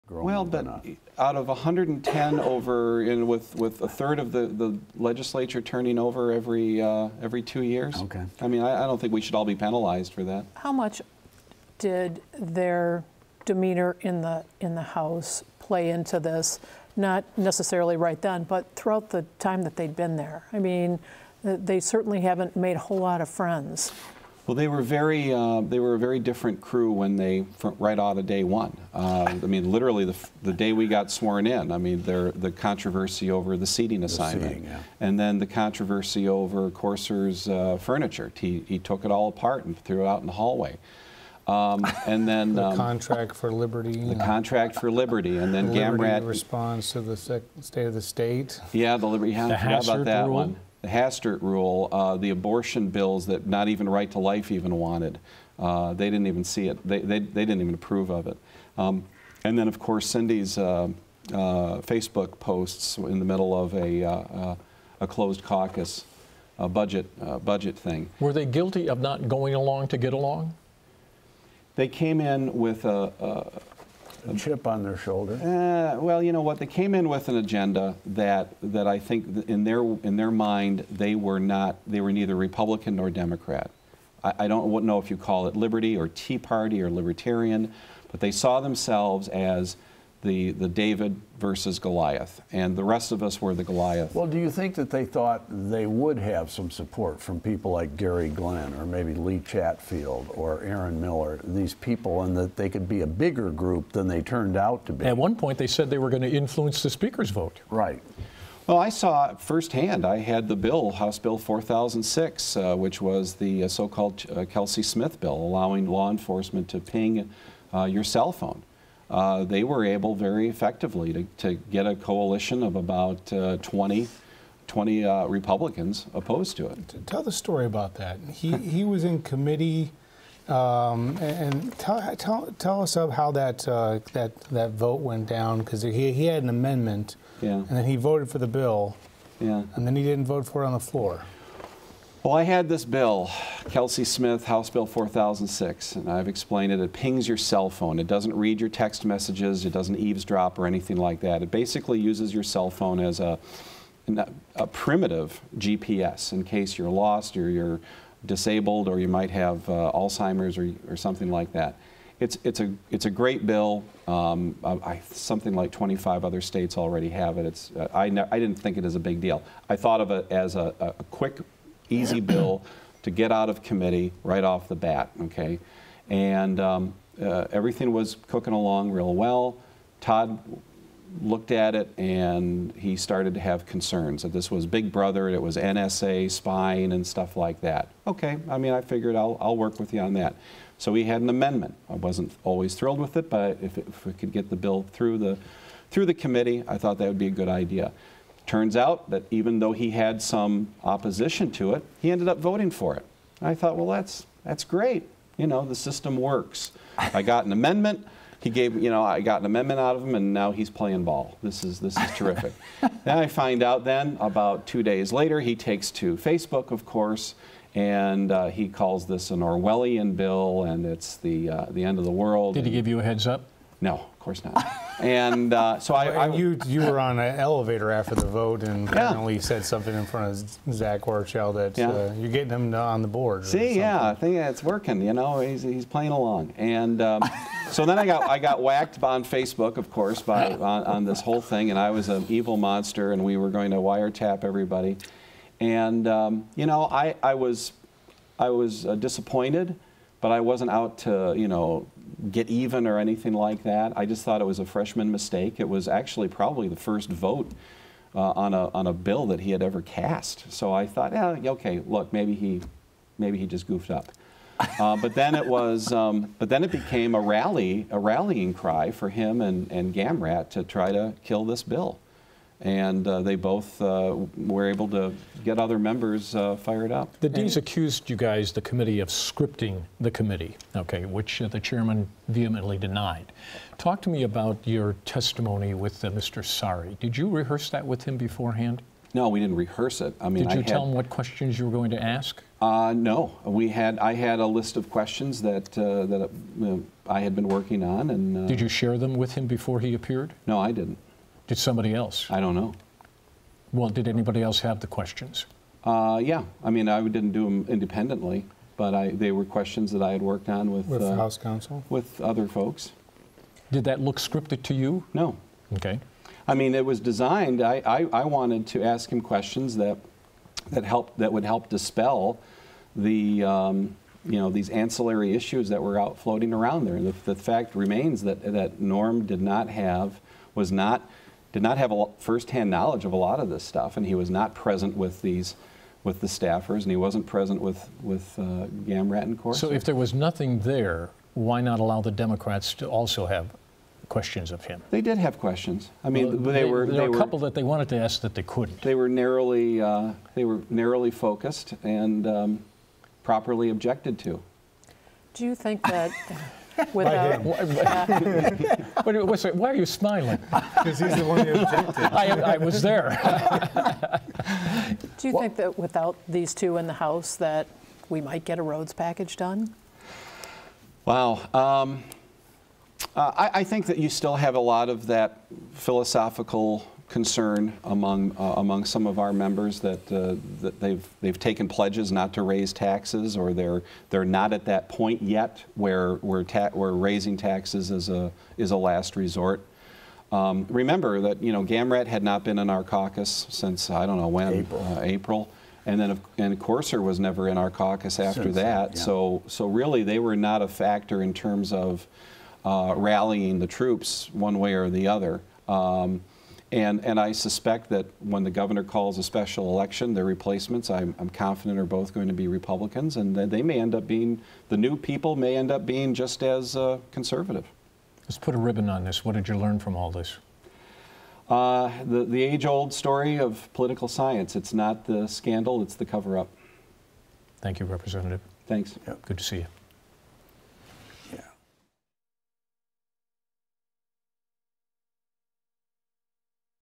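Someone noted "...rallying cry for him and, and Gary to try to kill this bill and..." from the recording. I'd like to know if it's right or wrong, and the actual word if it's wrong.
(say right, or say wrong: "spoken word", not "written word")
wrong: "Gamrat", not "Gary".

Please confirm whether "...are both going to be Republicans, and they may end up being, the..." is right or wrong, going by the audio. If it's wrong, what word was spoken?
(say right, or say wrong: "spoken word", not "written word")
right.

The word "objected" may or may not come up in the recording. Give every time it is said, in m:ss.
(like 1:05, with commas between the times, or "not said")
5:53, 6:01.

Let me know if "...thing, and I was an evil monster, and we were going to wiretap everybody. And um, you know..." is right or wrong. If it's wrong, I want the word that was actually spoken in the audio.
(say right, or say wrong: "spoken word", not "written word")
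right.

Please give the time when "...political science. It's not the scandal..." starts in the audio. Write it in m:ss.
7:03.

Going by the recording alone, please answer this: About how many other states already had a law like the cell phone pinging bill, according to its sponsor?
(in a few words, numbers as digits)
25.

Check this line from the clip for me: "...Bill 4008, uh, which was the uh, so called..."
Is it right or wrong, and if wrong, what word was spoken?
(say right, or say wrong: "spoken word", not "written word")
wrong: "4006", not "4008".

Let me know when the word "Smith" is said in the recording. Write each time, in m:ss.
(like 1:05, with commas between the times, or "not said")
1:54, 2:24.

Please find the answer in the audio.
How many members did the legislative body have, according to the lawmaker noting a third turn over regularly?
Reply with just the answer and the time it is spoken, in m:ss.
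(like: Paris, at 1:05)
110, at 0:01.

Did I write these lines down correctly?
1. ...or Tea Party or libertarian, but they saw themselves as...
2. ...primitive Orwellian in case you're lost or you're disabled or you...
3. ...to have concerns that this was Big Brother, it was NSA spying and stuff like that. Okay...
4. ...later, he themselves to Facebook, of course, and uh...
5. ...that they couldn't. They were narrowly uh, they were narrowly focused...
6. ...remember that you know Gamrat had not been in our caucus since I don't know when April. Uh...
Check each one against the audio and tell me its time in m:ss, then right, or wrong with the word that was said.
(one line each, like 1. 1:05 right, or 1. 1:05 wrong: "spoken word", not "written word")
1. 1:25 right
2. 2:34 wrong: "GPS", not "Orwellian"
3. 3:03 right
4. 3:35 wrong: "takes", not "themselves"
5. 5:48 right
6. 6:30 right.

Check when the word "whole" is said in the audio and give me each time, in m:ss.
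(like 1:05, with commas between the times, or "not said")
0:22, 4:01.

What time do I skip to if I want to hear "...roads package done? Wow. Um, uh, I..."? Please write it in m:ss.
6:08.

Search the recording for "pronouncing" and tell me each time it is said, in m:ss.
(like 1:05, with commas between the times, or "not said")
not said.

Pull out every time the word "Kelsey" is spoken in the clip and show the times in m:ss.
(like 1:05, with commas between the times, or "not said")
1:54, 2:23.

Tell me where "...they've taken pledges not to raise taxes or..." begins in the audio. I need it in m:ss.
6:21.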